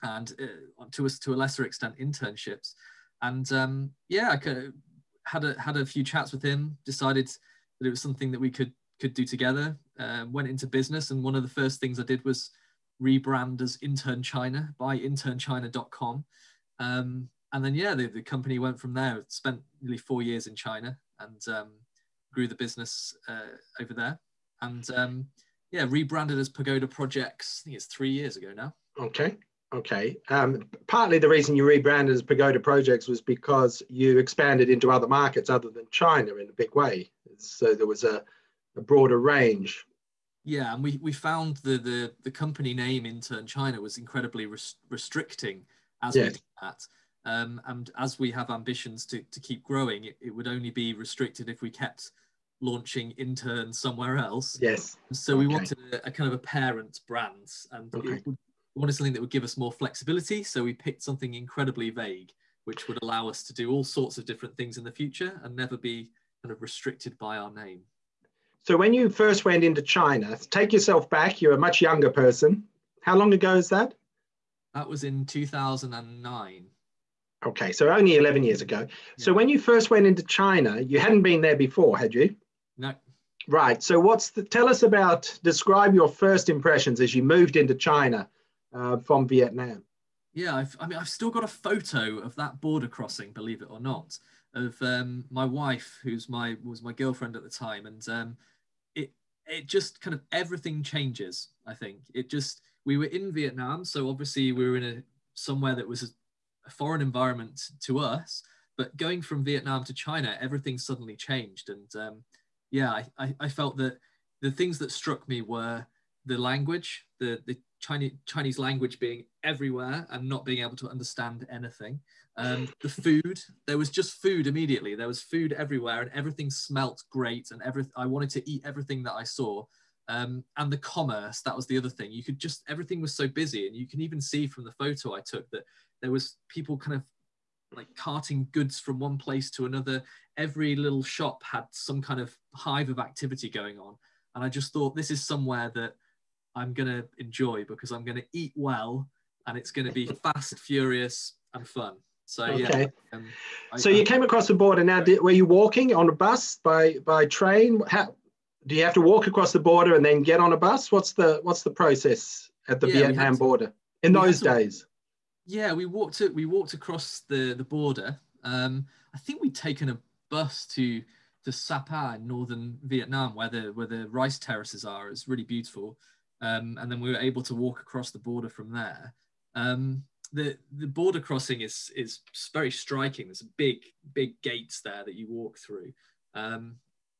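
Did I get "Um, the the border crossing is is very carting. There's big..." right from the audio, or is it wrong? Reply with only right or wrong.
wrong.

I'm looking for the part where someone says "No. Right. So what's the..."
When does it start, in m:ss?
1:22.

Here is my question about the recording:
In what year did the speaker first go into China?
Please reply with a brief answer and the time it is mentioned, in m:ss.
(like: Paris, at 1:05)
2009, at 1:15.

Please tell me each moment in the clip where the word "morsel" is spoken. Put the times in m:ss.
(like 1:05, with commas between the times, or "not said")
not said.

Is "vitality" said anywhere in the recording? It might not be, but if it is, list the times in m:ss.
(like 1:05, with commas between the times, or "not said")
not said.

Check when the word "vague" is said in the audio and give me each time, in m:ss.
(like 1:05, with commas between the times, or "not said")
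1:01.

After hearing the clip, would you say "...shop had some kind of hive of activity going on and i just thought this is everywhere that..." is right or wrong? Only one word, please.
wrong.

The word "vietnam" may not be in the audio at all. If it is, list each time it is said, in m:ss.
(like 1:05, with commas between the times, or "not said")
1:29, 1:43, 1:49, 2:42, 2:52.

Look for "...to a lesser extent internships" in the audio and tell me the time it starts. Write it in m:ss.
0:01.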